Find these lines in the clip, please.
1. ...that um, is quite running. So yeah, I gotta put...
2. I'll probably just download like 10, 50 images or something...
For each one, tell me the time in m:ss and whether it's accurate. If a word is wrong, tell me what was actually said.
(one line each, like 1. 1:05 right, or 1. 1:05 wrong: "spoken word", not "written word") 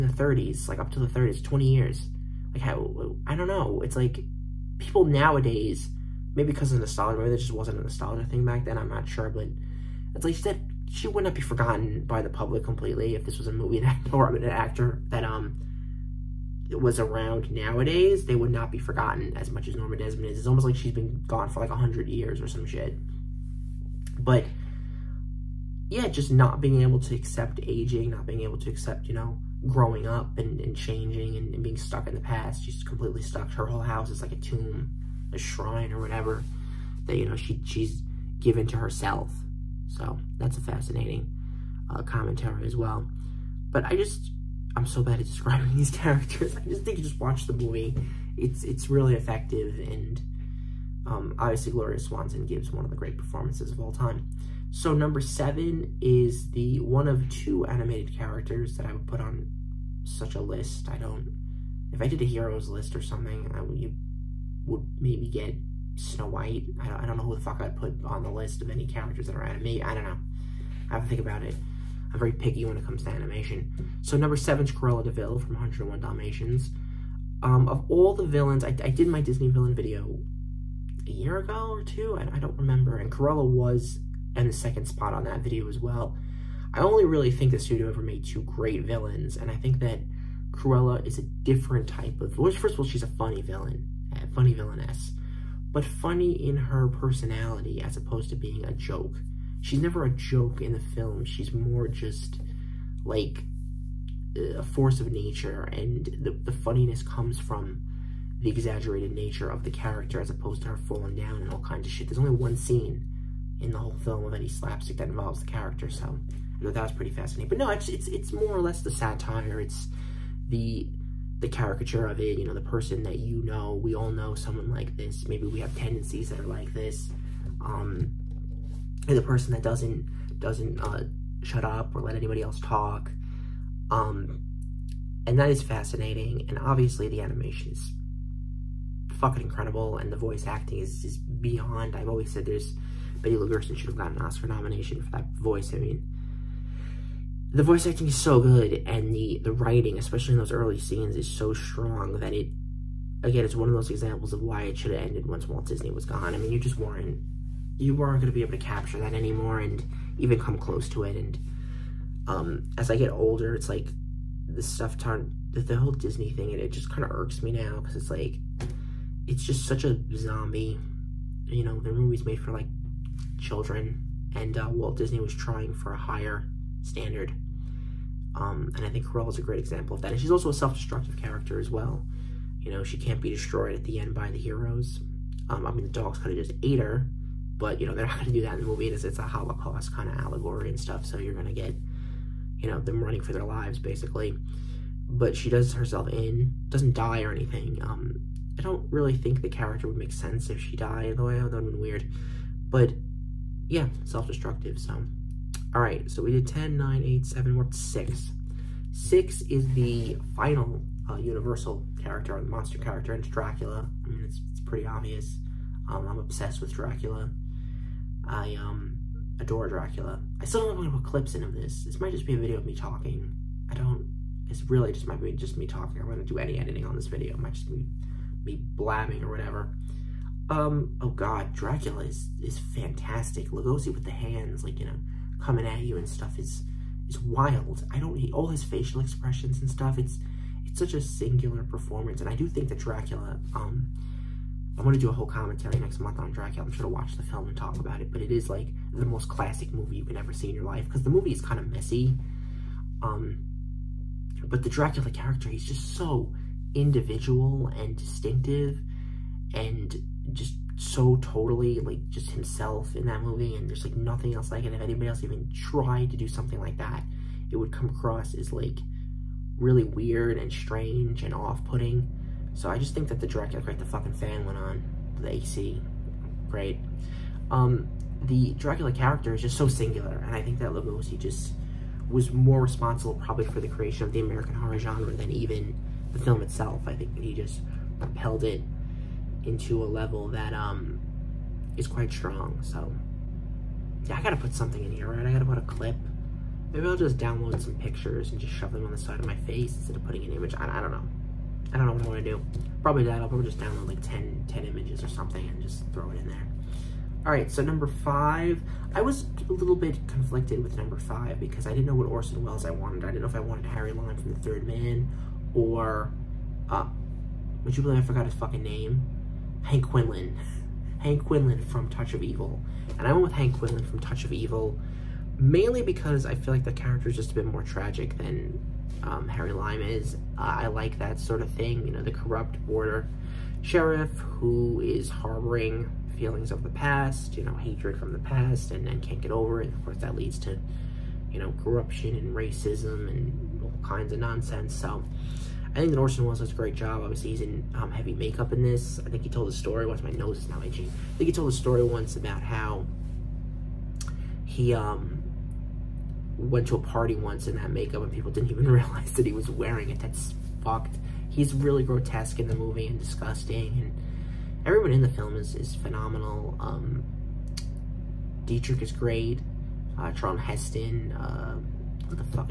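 1. 4:50 wrong: "strong", not "running"
2. 5:03 wrong: "10", not "50".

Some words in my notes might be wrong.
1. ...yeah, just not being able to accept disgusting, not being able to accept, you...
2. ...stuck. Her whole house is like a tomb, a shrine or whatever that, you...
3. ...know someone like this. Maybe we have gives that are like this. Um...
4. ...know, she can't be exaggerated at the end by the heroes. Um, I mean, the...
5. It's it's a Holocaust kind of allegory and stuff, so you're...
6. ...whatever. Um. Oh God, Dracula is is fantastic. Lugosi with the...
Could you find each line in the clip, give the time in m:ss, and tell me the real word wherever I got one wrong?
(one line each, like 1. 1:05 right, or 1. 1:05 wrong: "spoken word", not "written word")
1. 0:25 wrong: "aging", not "disgusting"
2. 0:33 right
3. 2:04 wrong: "tendencies", not "gives"
4. 3:02 wrong: "destroyed", not "exaggerated"
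5. 3:08 right
6. 3:49 right.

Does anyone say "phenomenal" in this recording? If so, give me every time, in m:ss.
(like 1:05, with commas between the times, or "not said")
6:05.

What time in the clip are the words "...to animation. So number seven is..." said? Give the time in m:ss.
1:13.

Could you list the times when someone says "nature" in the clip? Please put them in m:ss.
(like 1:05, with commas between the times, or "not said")
1:45, 1:49.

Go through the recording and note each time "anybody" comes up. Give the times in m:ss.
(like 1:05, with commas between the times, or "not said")
2:12, 4:24.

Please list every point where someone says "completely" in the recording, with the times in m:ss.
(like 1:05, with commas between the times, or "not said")
0:12, 0:32.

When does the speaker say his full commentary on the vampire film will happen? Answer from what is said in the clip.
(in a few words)
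next month.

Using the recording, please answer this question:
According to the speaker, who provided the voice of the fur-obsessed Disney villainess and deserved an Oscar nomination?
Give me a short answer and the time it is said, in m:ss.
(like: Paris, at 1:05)
Betty Gerson, at 2:23.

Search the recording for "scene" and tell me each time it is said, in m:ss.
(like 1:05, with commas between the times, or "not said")
1:52, 2:30.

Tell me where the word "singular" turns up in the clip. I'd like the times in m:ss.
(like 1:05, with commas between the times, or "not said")
4:01, 4:39.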